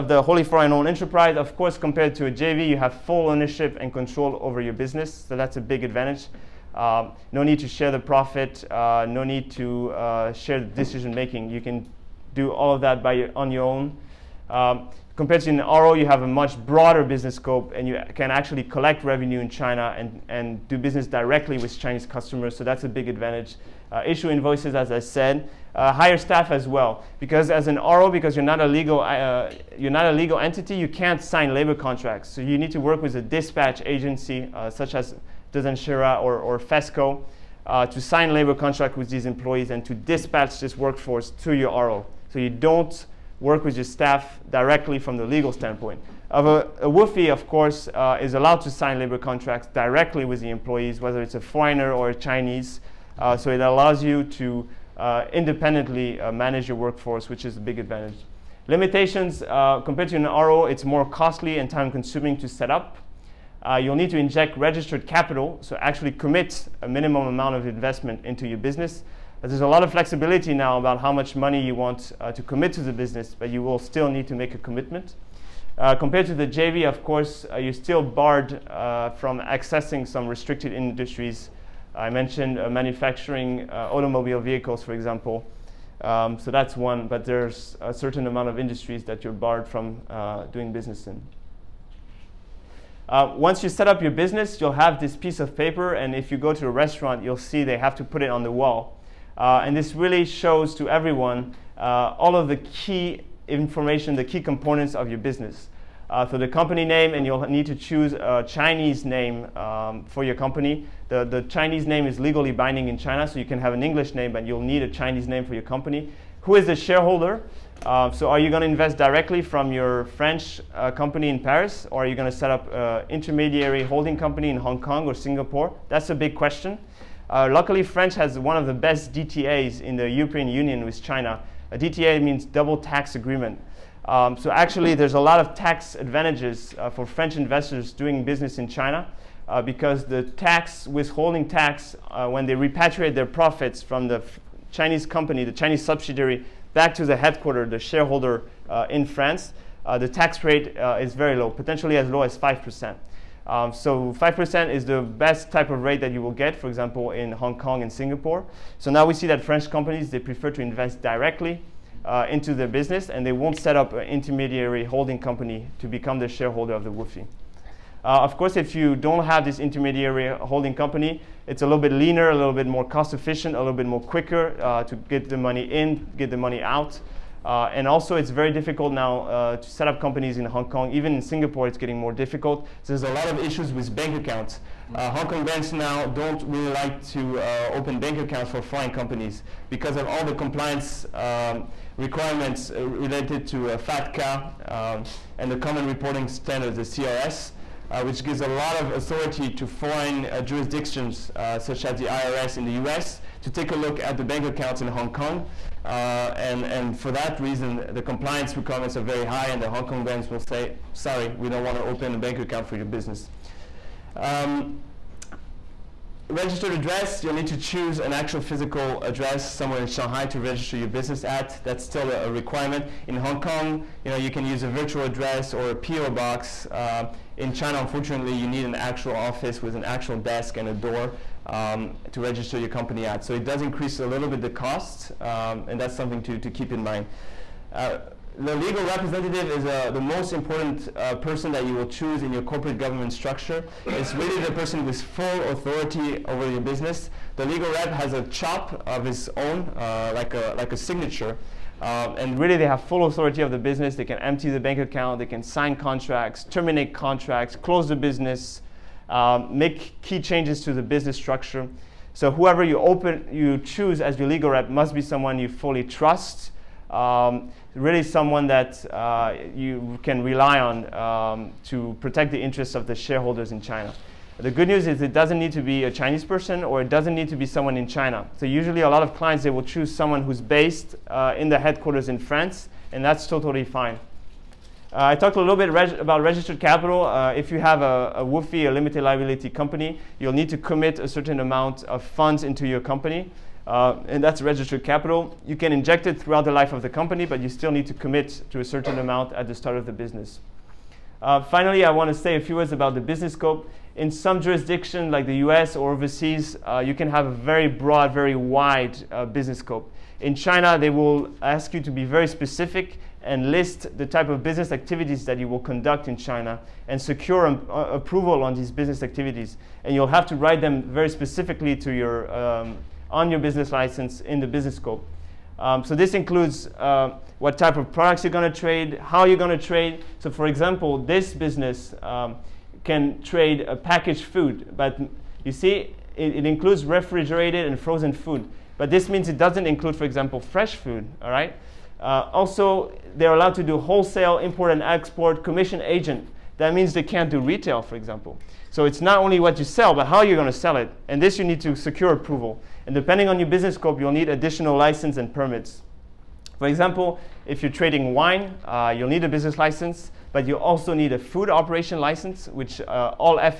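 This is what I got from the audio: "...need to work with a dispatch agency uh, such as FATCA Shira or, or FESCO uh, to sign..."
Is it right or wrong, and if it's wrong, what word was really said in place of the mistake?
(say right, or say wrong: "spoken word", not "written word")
wrong: "Dezan", not "FATCA".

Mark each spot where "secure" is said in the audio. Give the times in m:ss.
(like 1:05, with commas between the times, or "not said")
5:16, 5:51.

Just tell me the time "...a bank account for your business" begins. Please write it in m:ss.
3:32.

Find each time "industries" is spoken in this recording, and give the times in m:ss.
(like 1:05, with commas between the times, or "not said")
1:20, 1:28.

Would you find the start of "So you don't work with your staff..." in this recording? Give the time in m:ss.
0:42.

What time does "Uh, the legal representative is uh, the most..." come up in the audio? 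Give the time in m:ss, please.
3:57.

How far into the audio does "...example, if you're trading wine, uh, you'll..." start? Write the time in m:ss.
5:56.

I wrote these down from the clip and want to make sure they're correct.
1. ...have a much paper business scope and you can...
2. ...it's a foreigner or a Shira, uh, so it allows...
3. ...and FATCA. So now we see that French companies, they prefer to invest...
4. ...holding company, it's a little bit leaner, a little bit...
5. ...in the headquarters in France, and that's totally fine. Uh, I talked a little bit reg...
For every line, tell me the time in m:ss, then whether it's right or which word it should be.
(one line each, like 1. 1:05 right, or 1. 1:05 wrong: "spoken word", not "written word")
1. 0:16 wrong: "broader", not "paper"
2. 0:51 wrong: "Chinese", not "Shira"
3. 2:37 wrong: "Singapore", not "FATCA"
4. 2:50 right
5. 4:41 right.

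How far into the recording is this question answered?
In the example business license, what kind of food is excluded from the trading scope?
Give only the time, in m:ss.
5:40.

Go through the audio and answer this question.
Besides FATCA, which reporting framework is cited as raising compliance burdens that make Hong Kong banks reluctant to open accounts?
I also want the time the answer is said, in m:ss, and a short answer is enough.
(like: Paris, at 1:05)
Common Reporting Standards, at 3:15.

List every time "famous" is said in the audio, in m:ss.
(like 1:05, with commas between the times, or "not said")
not said.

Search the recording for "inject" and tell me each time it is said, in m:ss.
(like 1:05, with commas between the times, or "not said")
1:04, 4:55.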